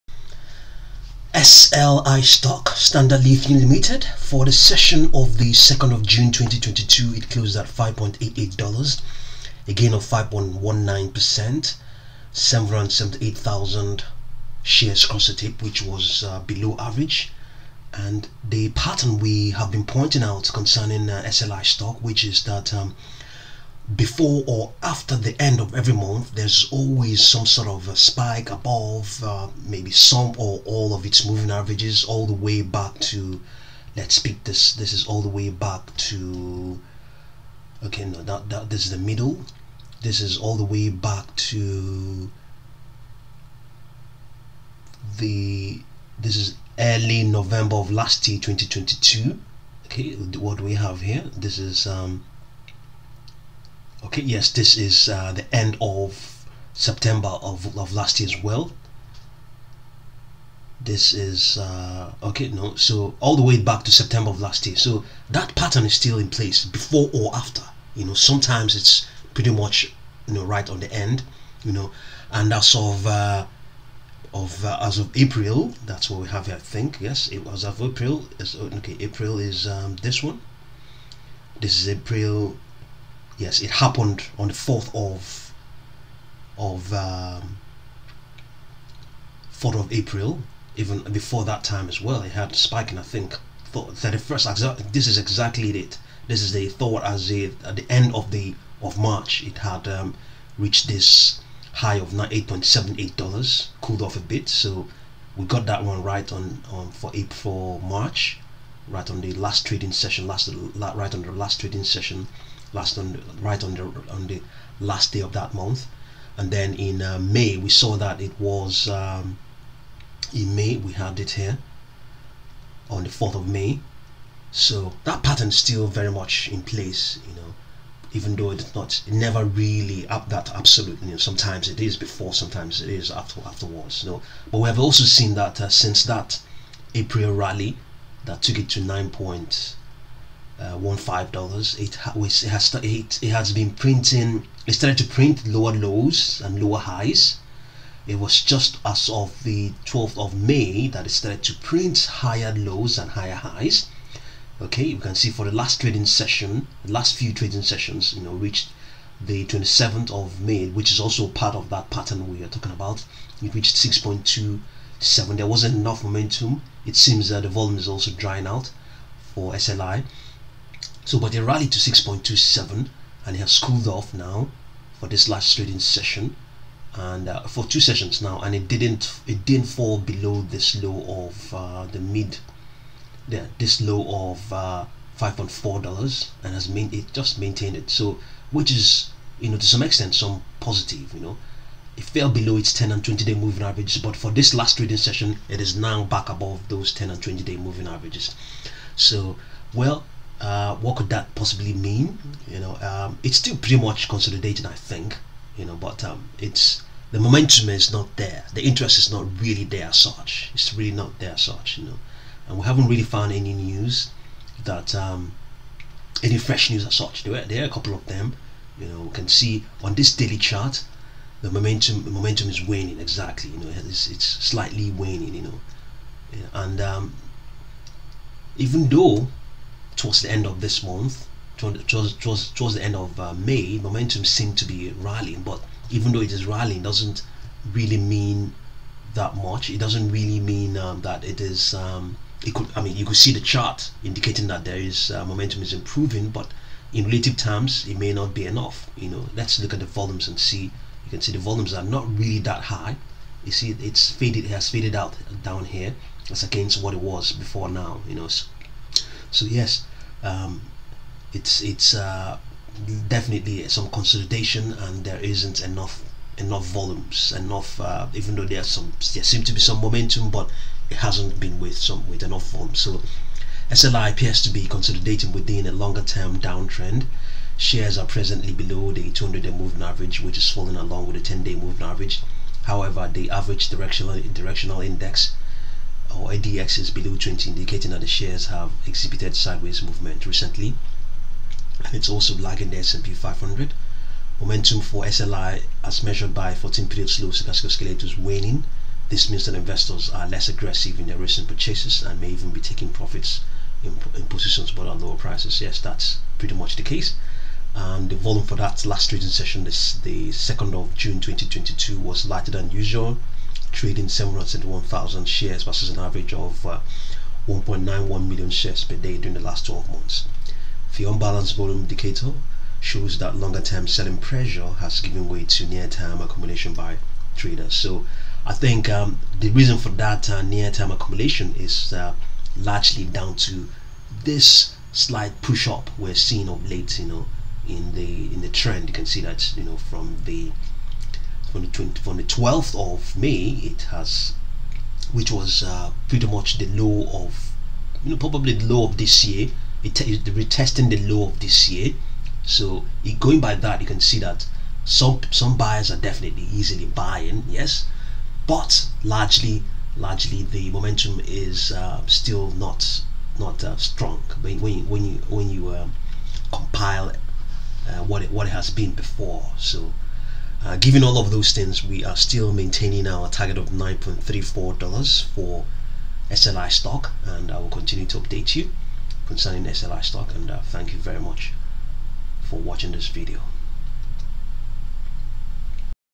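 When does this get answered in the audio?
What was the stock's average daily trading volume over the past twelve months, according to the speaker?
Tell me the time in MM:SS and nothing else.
05:17.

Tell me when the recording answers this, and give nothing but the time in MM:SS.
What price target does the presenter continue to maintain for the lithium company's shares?
06:13.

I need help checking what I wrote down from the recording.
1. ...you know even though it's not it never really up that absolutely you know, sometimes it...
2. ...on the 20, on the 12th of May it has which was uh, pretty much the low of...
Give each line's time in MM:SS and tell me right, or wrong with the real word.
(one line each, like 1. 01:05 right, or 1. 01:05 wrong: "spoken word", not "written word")
1. 02:07 right
2. 05:41 right.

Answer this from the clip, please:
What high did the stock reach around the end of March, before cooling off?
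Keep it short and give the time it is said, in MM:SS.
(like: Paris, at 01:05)
$8.78, at 01:42.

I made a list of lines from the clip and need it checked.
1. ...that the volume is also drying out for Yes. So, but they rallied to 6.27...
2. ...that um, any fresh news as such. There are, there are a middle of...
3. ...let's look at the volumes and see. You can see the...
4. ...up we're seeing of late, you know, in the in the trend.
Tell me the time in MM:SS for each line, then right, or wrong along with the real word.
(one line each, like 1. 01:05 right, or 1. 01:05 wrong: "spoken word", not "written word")
1. 02:47 wrong: "SLI", not "Yes"
2. 03:34 wrong: "couple", not "middle"
3. 04:09 right
4. 05:35 right.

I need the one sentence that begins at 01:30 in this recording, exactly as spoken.
Even before that time as well, it had spiking.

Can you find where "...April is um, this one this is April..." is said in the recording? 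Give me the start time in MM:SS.
01:18.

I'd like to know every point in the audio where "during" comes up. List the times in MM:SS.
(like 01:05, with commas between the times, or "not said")
05:19.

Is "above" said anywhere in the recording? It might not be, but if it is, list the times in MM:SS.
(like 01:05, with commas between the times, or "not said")
00:28, 03:16.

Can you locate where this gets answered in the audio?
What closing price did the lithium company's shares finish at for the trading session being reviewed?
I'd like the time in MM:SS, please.
00:07.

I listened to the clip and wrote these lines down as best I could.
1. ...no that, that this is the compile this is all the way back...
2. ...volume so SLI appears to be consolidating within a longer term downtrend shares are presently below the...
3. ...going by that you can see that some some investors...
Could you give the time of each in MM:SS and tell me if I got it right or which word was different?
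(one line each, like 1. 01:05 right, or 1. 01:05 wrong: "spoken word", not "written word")
1. 00:38 wrong: "middle", not "compile"
2. 04:32 right
3. 05:53 wrong: "buyers", not "investors".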